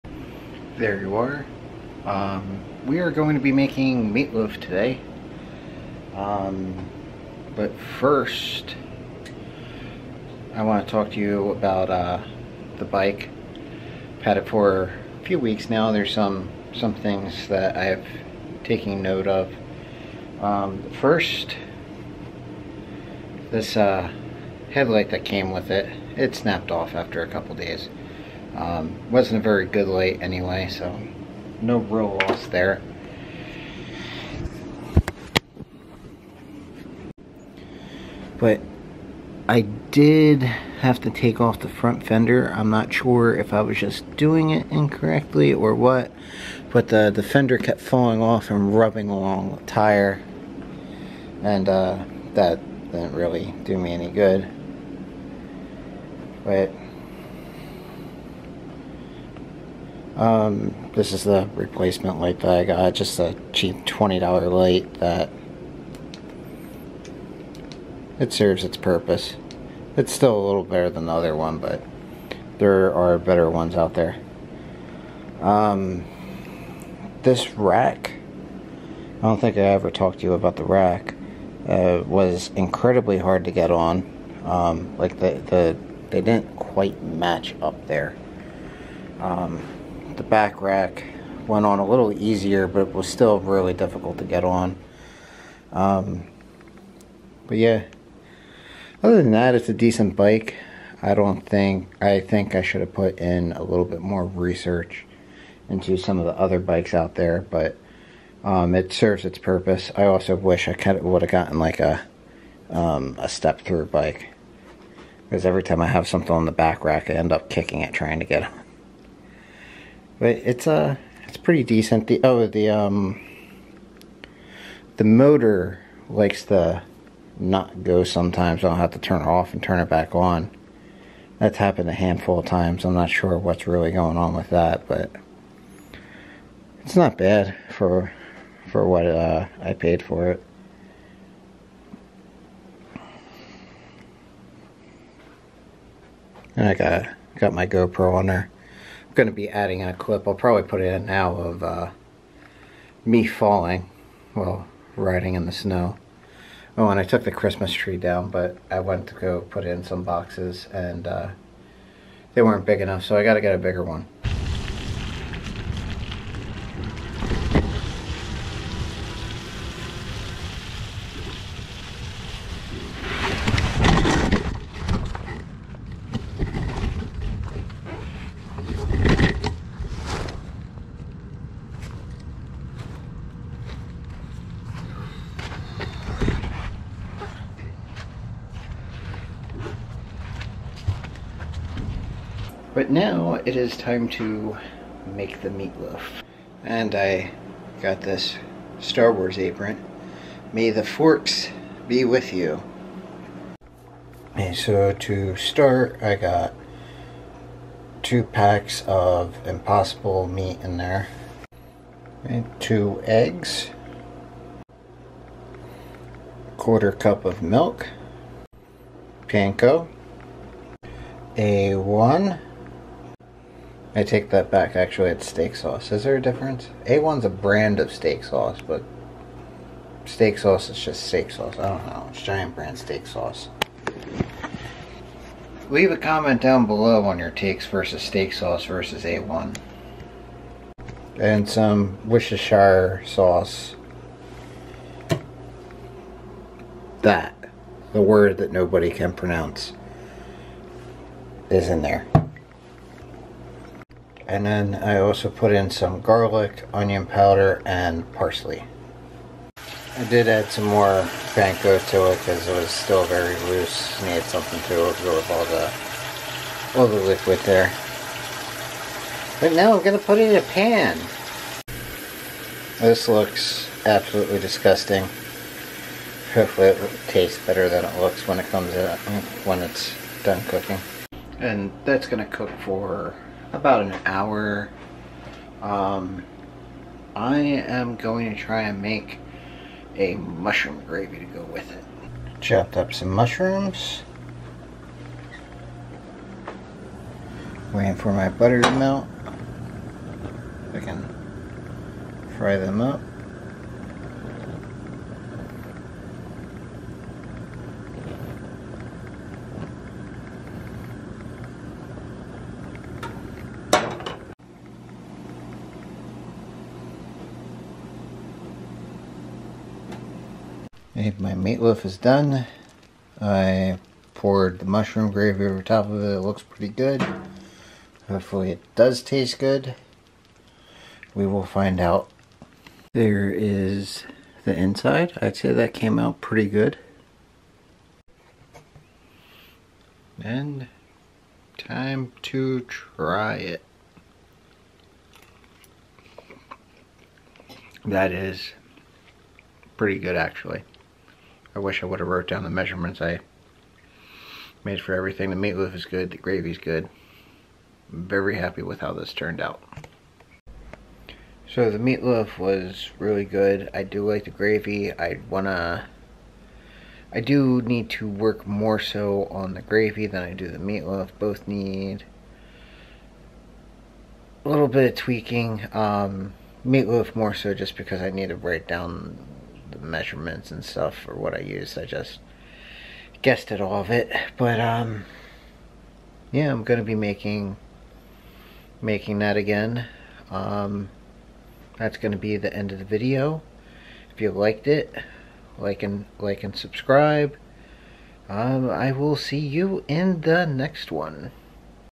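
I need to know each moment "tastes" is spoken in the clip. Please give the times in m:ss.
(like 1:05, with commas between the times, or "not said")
4:37, 5:29.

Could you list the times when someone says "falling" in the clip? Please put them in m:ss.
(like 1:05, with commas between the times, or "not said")
0:47, 2:33.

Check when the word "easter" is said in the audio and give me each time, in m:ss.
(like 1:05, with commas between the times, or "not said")
not said.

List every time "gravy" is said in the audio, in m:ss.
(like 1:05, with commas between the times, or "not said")
4:50, 5:25, 5:56, 6:04, 6:09.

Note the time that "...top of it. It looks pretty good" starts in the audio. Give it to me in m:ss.
5:25.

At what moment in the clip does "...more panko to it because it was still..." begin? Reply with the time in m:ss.
4:20.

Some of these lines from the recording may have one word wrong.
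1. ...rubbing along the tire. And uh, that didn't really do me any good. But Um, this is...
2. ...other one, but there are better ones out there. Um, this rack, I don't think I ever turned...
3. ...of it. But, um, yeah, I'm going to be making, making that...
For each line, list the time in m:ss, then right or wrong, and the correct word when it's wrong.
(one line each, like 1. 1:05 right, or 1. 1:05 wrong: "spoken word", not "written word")
1. 0:48 right
2. 1:11 wrong: "talked", not "turned"
3. 6:23 right.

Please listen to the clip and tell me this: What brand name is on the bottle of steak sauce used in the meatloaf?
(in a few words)
Giant.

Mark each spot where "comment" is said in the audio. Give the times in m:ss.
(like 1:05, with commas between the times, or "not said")
3:55.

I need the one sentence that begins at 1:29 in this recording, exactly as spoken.
Um, the back rack went on a little easier, but it was still really difficult to get on.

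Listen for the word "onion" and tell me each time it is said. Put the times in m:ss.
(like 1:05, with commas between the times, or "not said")
4:16.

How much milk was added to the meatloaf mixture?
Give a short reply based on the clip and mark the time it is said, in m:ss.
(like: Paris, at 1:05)
quarter cup, at 3:36.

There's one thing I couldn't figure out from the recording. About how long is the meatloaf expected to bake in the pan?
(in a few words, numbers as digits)
about an hour.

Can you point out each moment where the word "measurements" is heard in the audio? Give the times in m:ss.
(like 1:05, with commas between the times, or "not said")
5:52, 6:19.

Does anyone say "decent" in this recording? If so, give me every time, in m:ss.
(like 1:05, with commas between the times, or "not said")
1:39, 2:01.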